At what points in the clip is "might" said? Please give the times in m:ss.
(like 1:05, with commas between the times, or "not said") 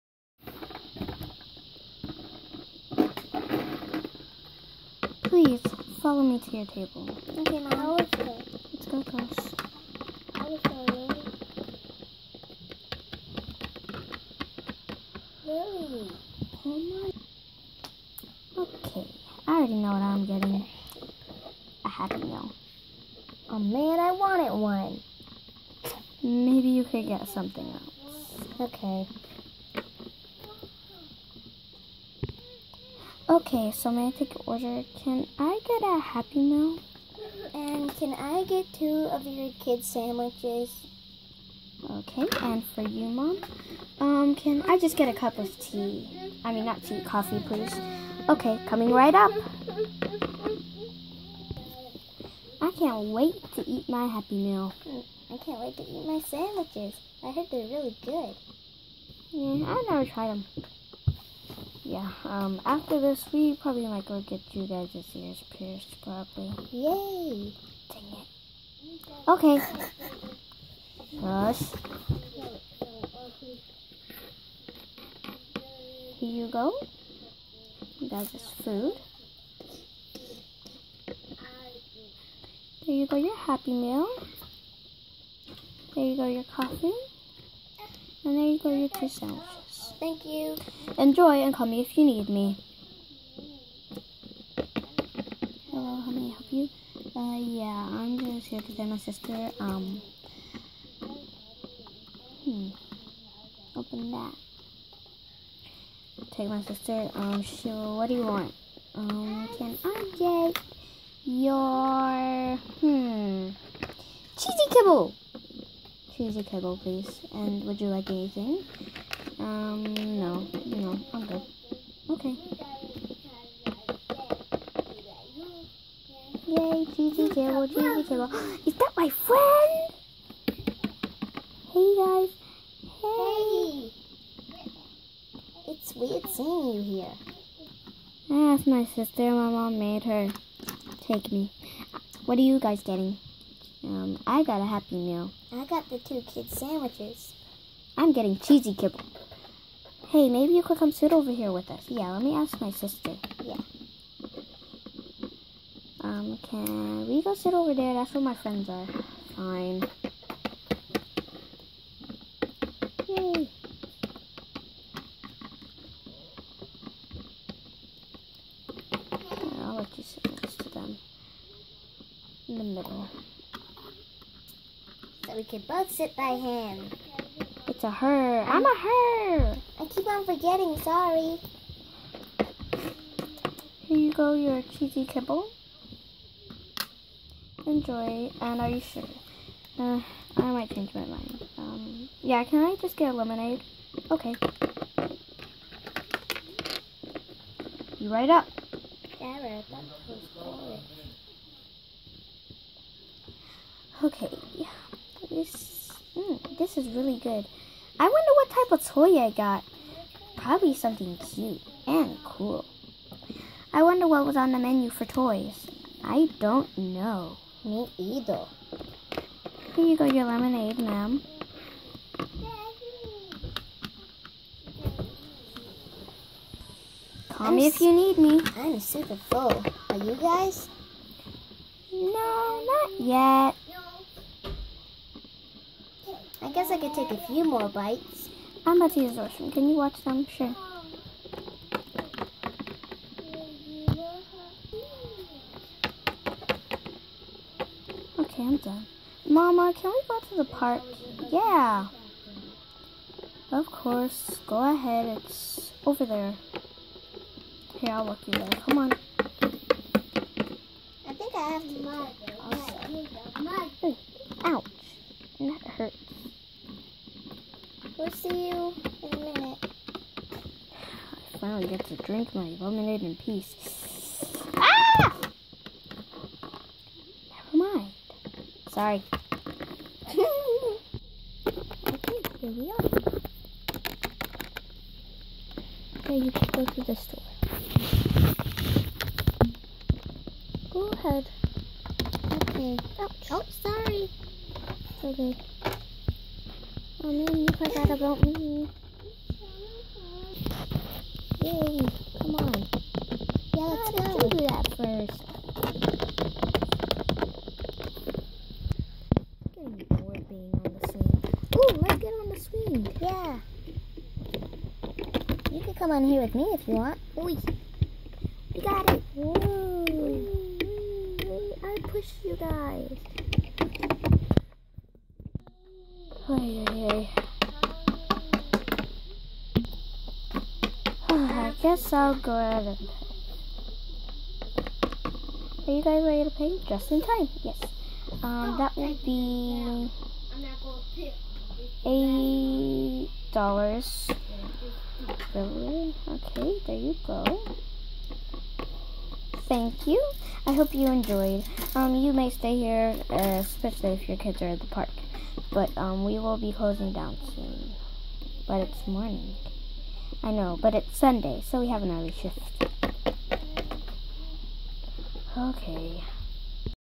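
1:03, 3:10.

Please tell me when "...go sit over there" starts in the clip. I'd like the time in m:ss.
2:37.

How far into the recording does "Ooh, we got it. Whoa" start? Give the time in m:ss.
5:17.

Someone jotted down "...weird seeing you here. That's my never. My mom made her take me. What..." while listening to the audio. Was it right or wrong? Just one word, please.
wrong.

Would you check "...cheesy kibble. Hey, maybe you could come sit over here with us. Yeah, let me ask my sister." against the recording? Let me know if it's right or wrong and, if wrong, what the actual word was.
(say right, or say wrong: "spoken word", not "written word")
right.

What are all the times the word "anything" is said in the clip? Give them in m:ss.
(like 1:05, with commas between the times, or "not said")
1:58.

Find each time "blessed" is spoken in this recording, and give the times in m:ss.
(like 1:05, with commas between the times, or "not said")
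not said.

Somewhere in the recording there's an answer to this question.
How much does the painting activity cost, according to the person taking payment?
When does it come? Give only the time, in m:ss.
5:41.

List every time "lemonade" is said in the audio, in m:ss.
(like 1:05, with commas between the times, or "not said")
3:13, 3:40, 4:32.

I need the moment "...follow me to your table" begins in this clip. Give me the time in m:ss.
0:06.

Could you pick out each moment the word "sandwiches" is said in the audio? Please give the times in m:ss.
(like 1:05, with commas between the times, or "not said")
0:39, 0:56, 2:26.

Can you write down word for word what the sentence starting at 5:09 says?
I'm getting bored being on the swing.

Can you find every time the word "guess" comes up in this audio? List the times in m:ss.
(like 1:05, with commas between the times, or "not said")
3:56, 5:31.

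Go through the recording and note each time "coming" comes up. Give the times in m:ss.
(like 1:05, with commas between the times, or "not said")
0:48.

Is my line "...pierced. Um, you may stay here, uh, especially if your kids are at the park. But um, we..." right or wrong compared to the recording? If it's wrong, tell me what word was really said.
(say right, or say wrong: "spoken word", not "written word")
wrong: "enjoyed", not "pierced".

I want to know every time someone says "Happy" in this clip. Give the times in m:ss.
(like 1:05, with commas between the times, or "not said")
0:21, 0:36, 0:54, 1:23, 2:24.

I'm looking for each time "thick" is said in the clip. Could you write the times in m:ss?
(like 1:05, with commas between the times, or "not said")
not said.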